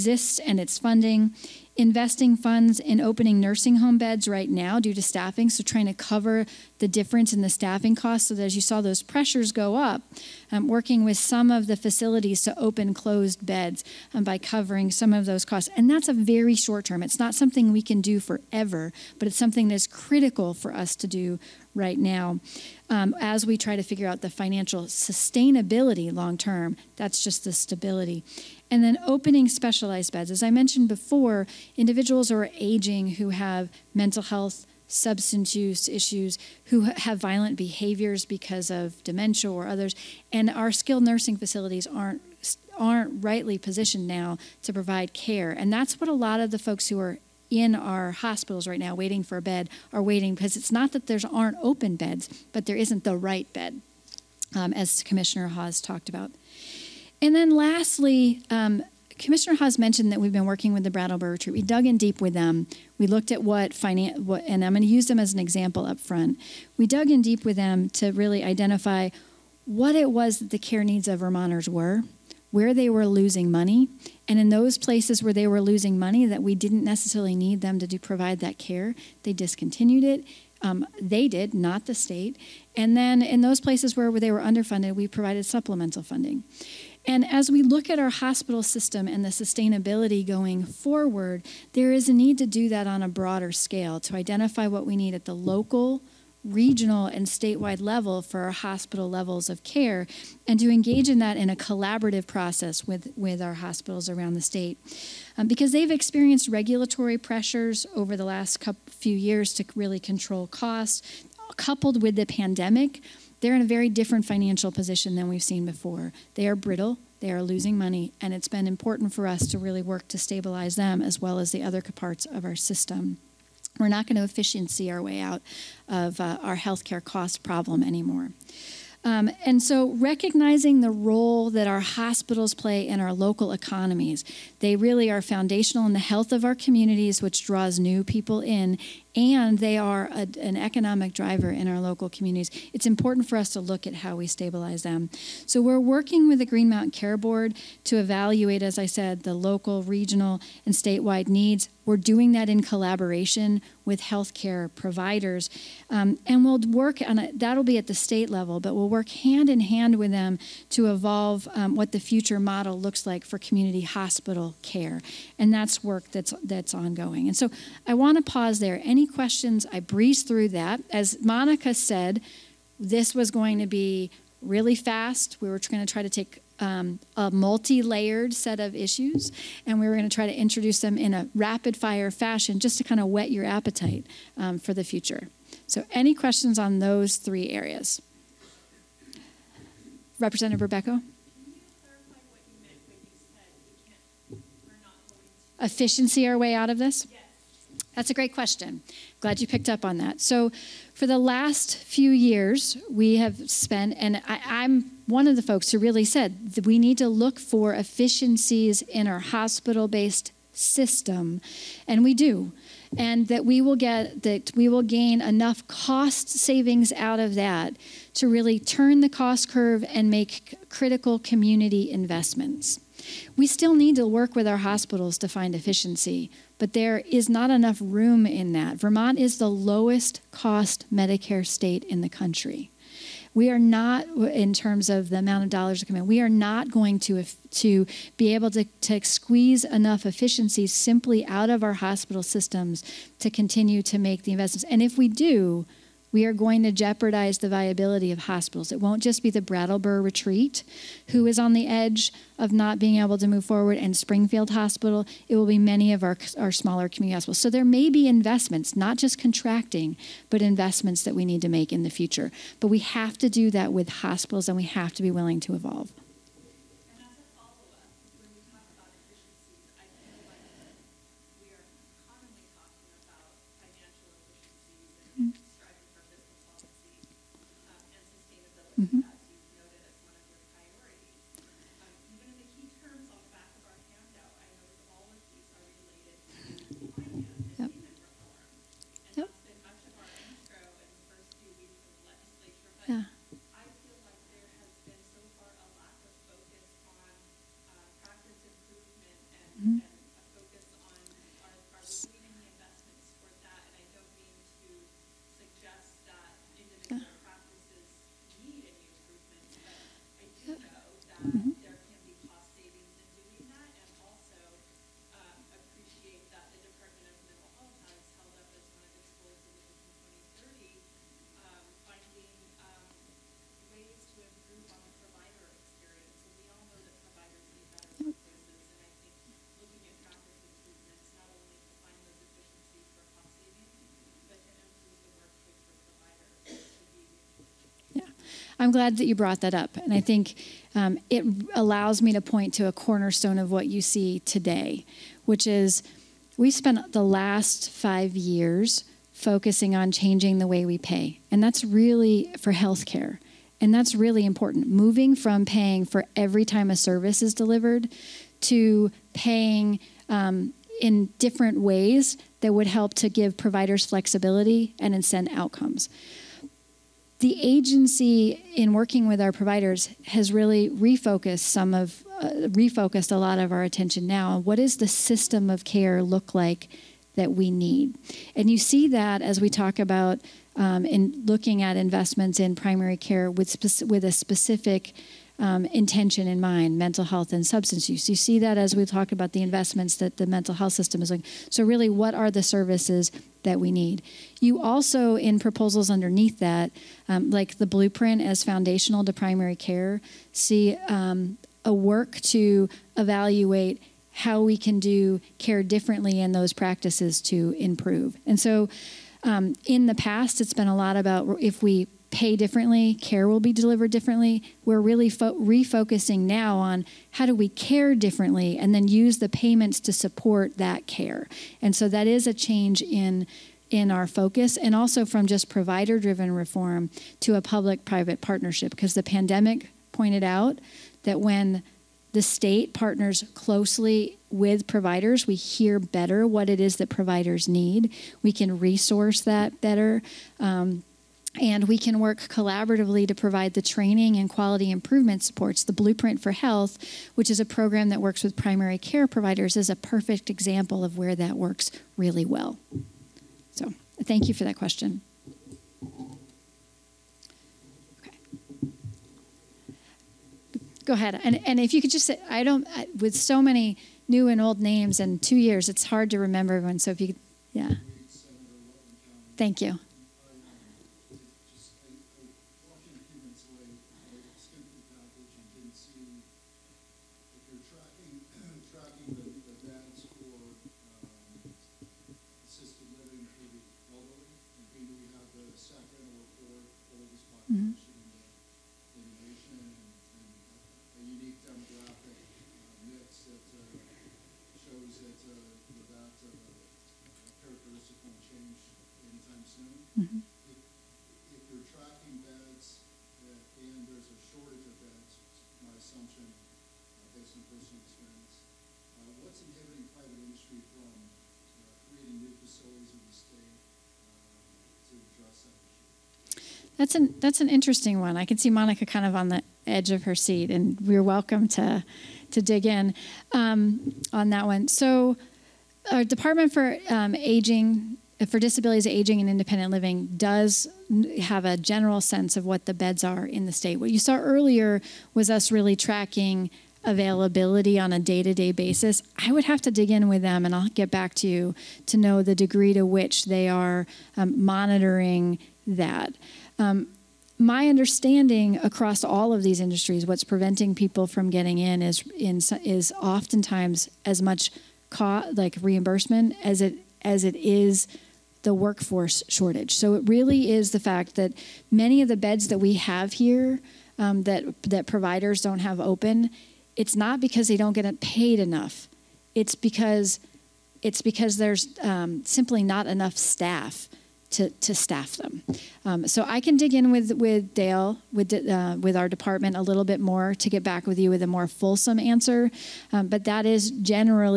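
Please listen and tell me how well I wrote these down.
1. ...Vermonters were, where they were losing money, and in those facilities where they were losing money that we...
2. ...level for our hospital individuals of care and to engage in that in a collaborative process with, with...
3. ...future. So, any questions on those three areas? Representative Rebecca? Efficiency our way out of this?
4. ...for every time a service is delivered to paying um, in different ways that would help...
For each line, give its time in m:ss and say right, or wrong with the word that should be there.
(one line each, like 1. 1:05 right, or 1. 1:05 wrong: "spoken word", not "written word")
1. 1:11 wrong: "places", not "facilities"
2. 1:37 wrong: "levels", not "individuals"
3. 3:04 right
4. 5:55 right.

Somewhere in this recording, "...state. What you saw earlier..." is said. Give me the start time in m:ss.
8:53.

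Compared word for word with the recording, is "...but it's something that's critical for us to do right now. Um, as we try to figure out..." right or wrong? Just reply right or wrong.
right.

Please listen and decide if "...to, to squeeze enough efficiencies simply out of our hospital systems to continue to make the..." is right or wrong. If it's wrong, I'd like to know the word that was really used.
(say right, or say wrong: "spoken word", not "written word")
right.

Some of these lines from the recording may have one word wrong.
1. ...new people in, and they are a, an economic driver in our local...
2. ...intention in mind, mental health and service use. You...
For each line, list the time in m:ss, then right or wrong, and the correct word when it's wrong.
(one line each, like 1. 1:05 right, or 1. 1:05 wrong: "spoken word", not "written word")
1. 2:17 right
2. 6:25 wrong: "substance", not "service".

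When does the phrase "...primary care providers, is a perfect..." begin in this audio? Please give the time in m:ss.
7:28.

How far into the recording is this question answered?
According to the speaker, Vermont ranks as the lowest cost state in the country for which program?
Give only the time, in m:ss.
3:50.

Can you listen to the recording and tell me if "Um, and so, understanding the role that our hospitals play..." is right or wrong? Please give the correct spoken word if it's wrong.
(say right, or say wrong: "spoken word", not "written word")
wrong: "recognizing", not "understanding".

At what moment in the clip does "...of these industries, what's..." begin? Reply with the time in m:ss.
9:09.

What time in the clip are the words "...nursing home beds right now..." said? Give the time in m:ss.
0:03.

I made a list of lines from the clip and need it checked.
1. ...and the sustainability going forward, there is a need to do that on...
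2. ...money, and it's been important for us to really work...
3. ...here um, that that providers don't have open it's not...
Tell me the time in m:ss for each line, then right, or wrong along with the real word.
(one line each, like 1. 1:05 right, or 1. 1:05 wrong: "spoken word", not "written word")
1. 1:29 right
2. 1:57 right
3. 9:23 right.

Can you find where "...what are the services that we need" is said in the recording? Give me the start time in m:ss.
6:31.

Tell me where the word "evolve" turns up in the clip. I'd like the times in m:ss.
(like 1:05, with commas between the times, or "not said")
2:40, 4:25.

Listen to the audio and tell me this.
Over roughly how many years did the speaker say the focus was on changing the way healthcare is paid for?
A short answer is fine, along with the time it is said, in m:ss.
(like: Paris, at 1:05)
5, at 5:47.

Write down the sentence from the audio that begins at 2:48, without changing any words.
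Any questions, I breezed through that.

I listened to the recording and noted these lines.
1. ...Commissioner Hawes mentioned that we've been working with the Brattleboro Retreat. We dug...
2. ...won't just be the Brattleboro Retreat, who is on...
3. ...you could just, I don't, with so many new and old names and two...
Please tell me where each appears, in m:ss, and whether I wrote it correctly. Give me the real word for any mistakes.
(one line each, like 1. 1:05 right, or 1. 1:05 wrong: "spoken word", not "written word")
1. 0:59 right
2. 4:08 right
3. 7:41 right.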